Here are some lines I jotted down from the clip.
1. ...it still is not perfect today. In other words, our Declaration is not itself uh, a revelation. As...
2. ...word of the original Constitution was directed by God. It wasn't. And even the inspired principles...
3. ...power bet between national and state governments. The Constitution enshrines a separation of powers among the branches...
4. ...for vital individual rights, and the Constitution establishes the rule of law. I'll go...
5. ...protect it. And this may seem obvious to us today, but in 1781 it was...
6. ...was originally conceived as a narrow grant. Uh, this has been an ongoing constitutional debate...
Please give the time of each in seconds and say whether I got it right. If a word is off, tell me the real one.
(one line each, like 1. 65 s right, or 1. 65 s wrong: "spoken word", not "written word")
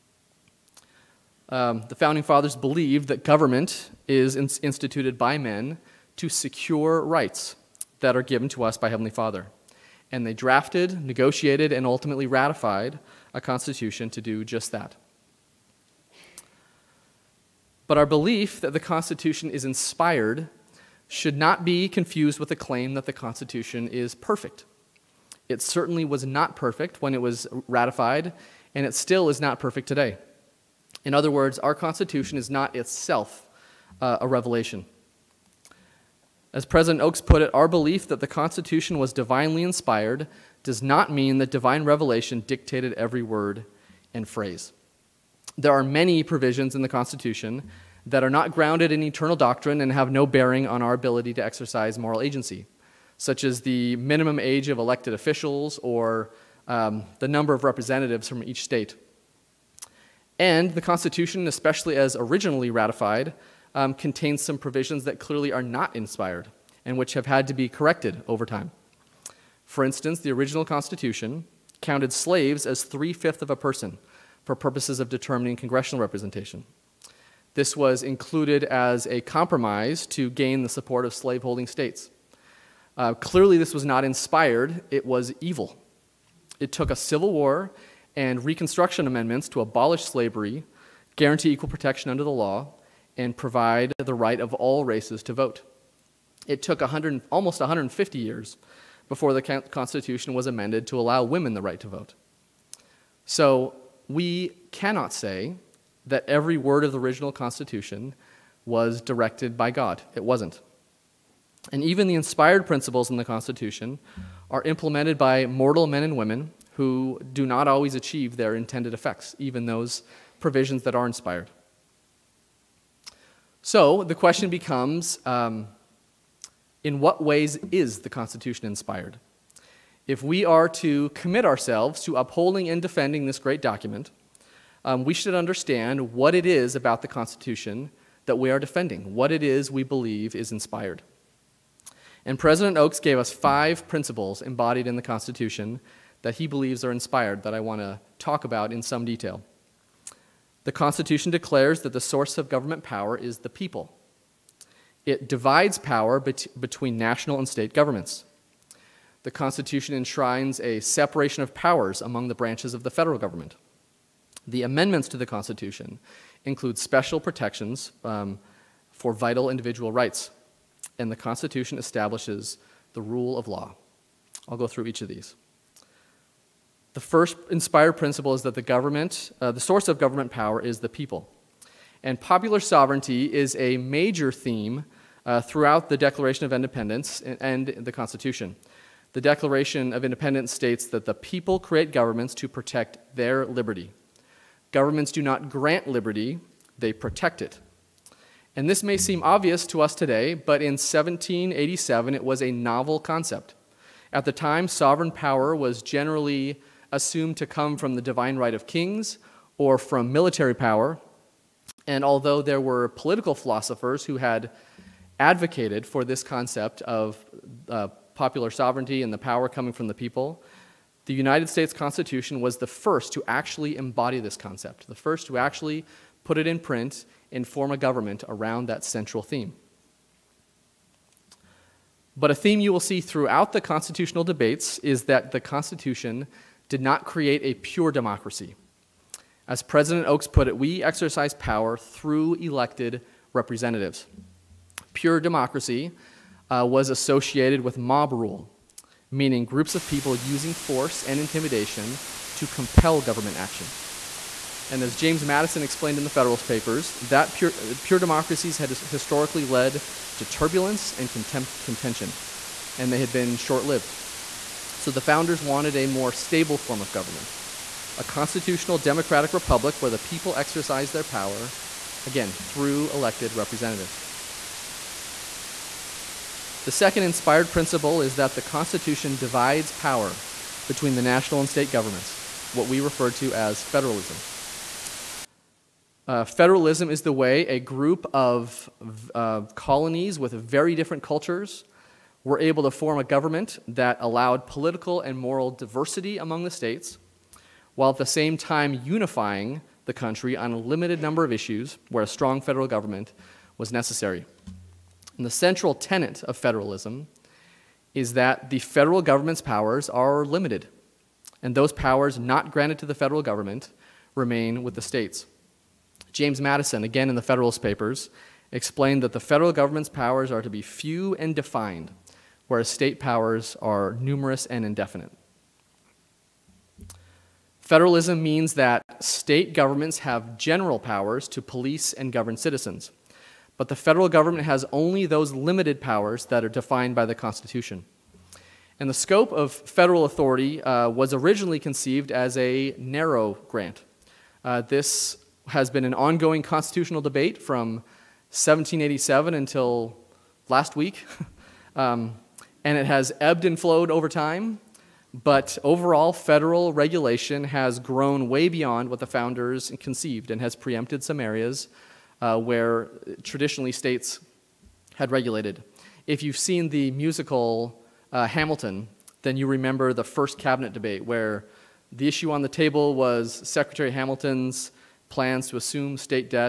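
1. 28 s wrong: "Constitution", not "Declaration"
2. 106 s right
3. 155 s right
4. 168 s right
5. 196 s wrong: "1787", not "1781"
6. 340 s right.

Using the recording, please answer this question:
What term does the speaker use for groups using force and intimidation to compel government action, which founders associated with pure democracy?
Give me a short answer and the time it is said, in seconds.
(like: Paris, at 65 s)
mob rule, at 247 s.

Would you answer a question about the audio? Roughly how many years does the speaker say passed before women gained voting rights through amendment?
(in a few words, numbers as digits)
almost 150 years.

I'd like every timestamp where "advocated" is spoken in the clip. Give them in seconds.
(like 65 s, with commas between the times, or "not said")
215 s.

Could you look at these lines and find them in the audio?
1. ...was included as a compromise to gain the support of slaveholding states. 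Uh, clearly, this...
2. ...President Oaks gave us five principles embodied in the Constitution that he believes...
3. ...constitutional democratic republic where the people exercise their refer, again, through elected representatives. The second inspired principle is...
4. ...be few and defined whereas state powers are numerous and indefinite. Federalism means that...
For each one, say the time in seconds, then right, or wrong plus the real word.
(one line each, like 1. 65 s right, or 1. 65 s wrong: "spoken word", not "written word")
1. 77 s right
2. 142 s right
3. 268 s wrong: "power", not "refer"
4. 320 s right.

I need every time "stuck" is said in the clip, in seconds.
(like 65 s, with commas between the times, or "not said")
not said.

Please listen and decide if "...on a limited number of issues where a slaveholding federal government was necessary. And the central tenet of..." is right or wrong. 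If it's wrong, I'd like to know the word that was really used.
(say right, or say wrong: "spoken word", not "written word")
wrong: "strong", not "slaveholding".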